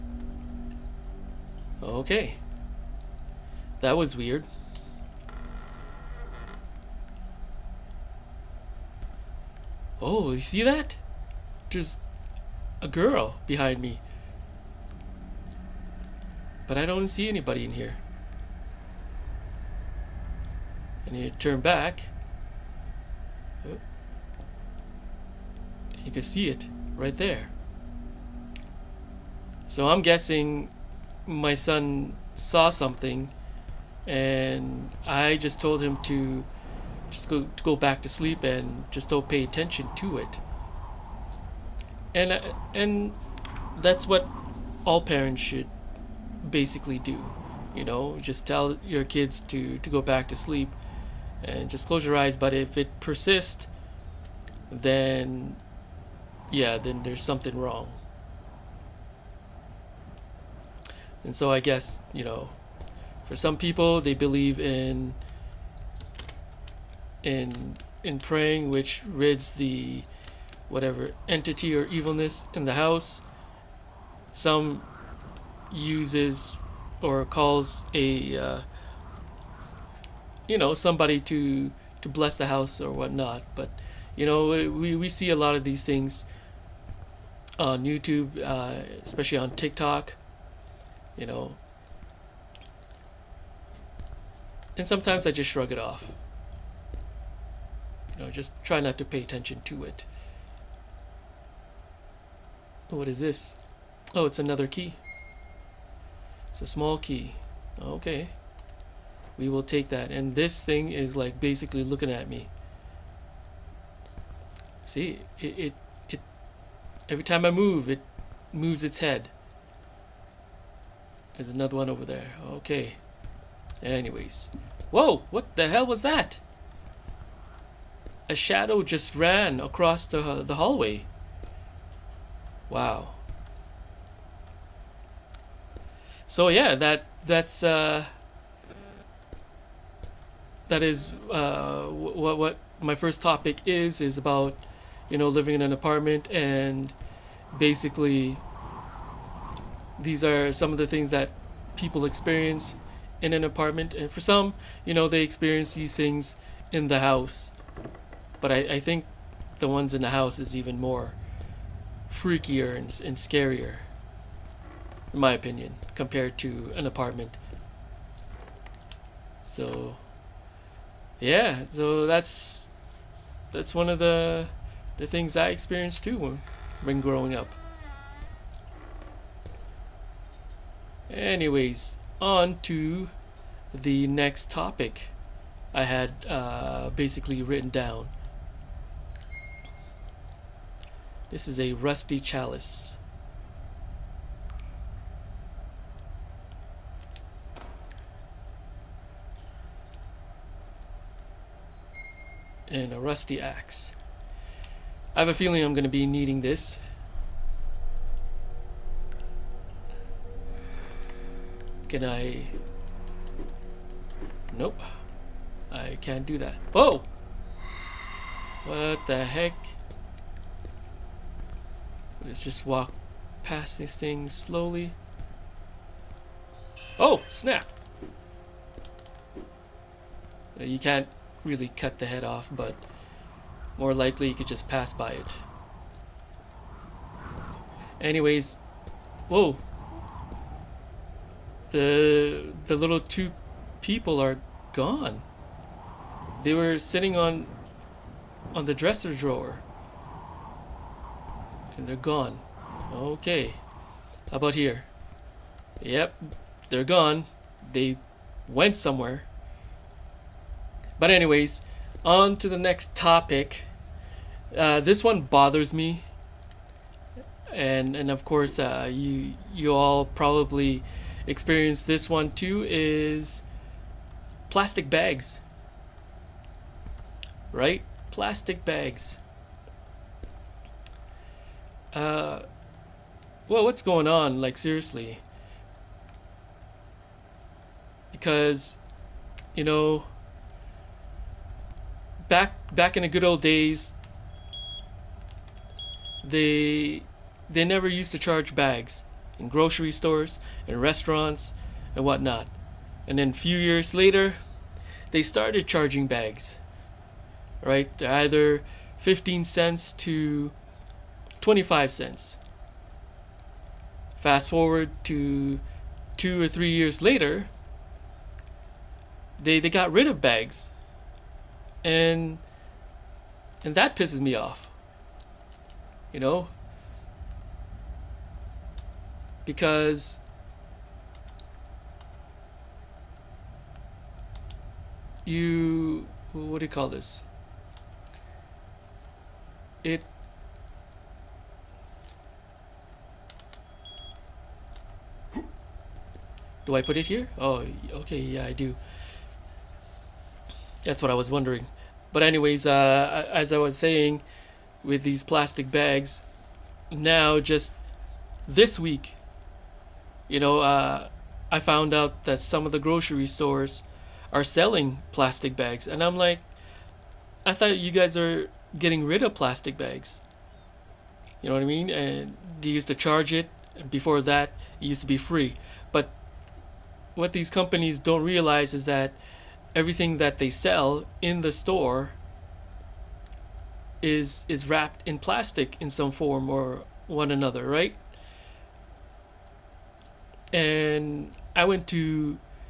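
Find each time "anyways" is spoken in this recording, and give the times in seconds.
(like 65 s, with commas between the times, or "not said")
123 s, 181 s, 238 s, 261 s, 352 s.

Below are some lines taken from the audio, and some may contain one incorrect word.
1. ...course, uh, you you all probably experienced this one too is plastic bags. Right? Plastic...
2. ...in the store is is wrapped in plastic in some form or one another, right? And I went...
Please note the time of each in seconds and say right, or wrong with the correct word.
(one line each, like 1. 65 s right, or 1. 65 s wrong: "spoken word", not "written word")
1. 268 s right
2. 381 s right.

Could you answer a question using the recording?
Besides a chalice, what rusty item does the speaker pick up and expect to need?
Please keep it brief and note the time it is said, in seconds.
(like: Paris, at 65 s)
axe, at 202 s.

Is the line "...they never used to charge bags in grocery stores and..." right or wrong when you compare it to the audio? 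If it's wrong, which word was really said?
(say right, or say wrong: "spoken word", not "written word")
right.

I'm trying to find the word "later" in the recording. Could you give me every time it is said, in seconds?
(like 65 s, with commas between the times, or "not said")
303 s, 317 s.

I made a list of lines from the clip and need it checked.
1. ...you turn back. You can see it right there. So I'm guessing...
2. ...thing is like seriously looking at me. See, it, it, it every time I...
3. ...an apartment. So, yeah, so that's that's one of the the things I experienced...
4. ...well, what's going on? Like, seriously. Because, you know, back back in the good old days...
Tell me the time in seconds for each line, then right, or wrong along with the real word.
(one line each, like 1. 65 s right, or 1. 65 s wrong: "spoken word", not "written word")
1. 21 s right
2. 110 s wrong: "basically", not "seriously"
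3. 166 s right
4. 283 s right.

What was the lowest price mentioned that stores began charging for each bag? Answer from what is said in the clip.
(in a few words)
15 cents.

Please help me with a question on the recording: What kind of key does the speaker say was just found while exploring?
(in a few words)
small key.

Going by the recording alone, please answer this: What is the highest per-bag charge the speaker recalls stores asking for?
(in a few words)
25 cents.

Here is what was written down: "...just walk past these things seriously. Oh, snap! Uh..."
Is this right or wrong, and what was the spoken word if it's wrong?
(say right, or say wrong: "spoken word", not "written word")
wrong: "slowly", not "seriously".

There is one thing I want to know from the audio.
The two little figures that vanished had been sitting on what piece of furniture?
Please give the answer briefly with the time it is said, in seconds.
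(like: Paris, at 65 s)
dresser drawer, at 248 s.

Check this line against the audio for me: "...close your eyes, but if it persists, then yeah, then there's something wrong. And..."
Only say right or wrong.
right.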